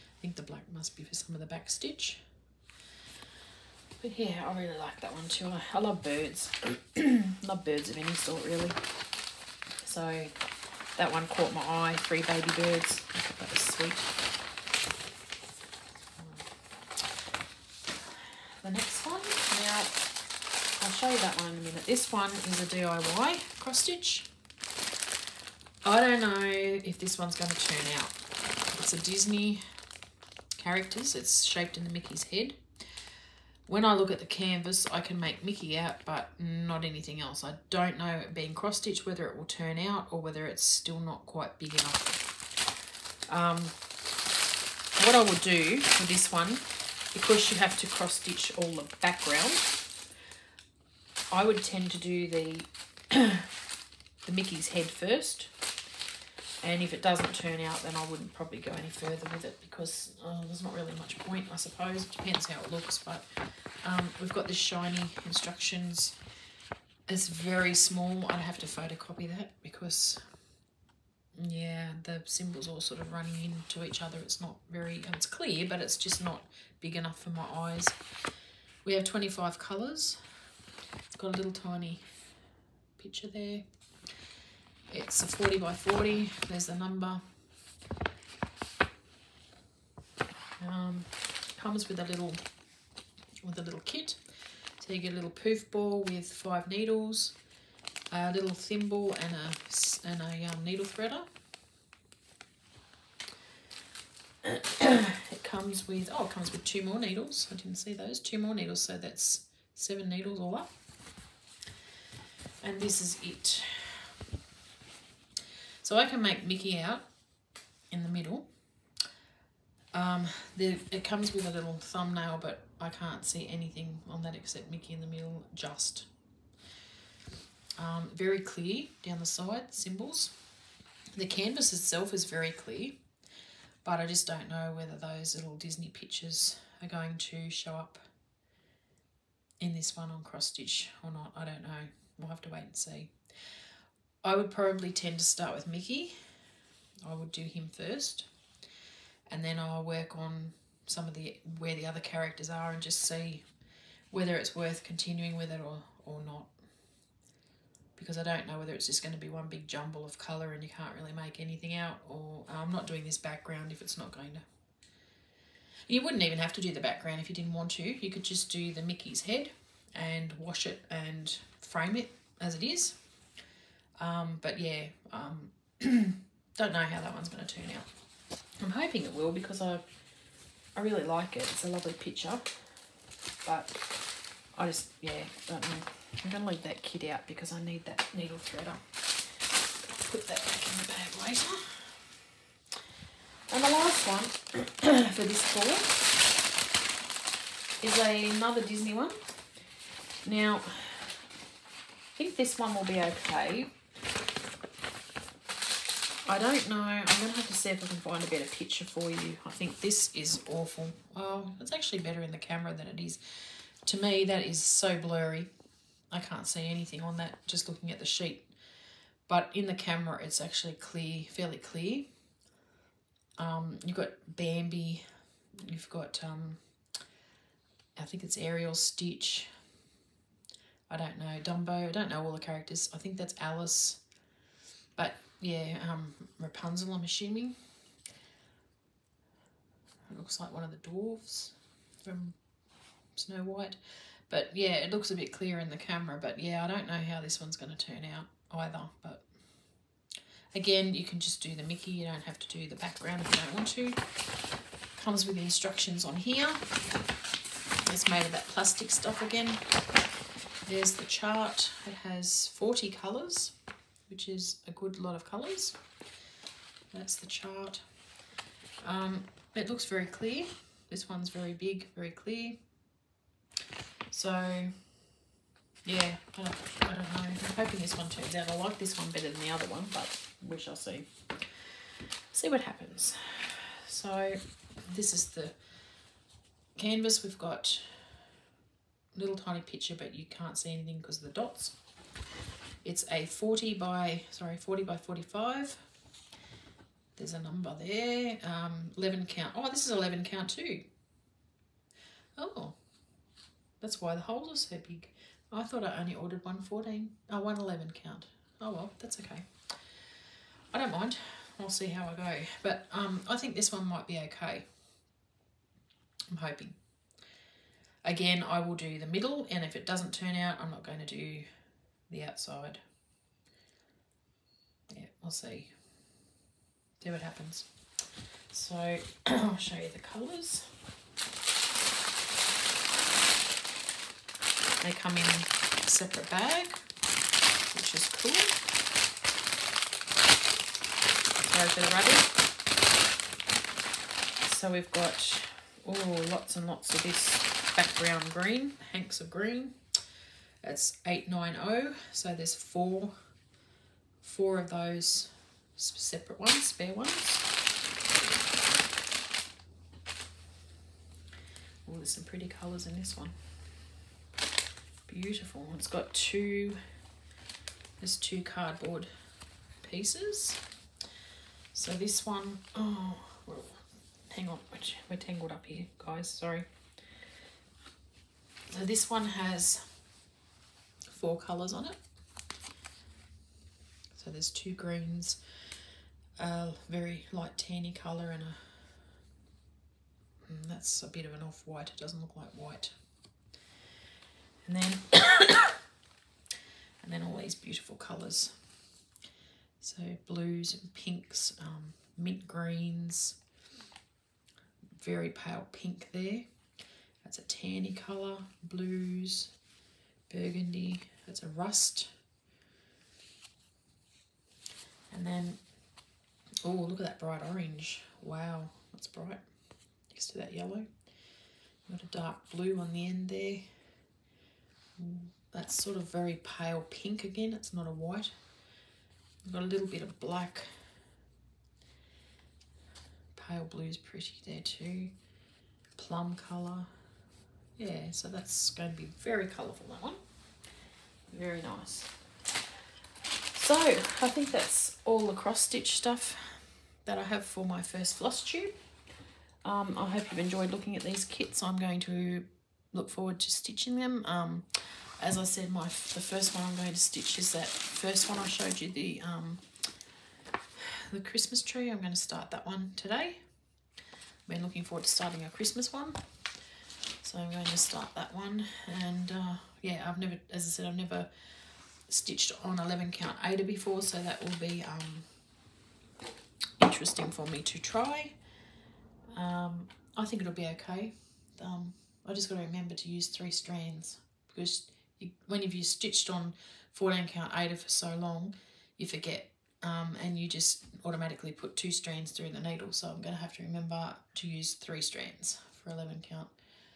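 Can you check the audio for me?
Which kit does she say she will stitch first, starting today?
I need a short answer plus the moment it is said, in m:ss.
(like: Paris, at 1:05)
The Christmas tree, at 7:41.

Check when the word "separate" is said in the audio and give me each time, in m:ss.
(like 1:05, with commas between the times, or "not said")
5:35, 5:55.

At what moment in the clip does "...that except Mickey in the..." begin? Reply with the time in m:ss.
2:04.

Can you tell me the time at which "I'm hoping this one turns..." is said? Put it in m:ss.
4:37.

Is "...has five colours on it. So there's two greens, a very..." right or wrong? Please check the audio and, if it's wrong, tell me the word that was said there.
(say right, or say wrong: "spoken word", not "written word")
wrong: "four", not "five".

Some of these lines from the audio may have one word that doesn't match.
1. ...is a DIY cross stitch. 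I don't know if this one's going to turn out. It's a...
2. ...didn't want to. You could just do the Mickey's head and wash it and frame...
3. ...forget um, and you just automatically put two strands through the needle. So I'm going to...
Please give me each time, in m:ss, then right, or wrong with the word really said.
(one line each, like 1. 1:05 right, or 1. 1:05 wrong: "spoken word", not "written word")
1. 0:22 right
2. 2:47 right
3. 8:09 right.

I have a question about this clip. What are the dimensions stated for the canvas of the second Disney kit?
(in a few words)
40 by 45.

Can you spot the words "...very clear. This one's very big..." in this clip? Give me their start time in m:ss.
4:29.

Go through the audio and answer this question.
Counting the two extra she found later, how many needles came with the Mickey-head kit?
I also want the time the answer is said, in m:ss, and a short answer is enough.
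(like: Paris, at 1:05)
7, at 1:49.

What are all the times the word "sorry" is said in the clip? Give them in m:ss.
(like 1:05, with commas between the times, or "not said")
4:54, 5:41, 6:16.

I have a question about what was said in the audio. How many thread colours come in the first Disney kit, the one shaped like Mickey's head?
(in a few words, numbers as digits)
25.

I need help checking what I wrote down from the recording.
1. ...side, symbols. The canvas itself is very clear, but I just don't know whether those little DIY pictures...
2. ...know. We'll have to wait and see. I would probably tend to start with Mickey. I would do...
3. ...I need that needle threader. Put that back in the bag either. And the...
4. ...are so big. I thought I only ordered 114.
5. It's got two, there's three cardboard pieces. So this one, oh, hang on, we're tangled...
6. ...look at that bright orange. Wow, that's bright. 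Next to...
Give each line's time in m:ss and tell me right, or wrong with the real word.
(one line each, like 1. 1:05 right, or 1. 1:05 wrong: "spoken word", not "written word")
1. 2:09 wrong: "Disney", not "DIY"
2. 2:21 right
3. 3:07 wrong: "later", not "either"
4. 5:04 right
5. 6:05 wrong: "two", not "three"
6. 6:56 right.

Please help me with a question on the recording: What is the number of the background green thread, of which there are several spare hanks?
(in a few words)
890.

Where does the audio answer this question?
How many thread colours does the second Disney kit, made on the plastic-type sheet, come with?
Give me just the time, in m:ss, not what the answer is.
4:22.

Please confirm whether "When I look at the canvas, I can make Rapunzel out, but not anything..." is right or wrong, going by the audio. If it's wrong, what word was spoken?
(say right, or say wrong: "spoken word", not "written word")
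wrong: "Mickey", not "Rapunzel".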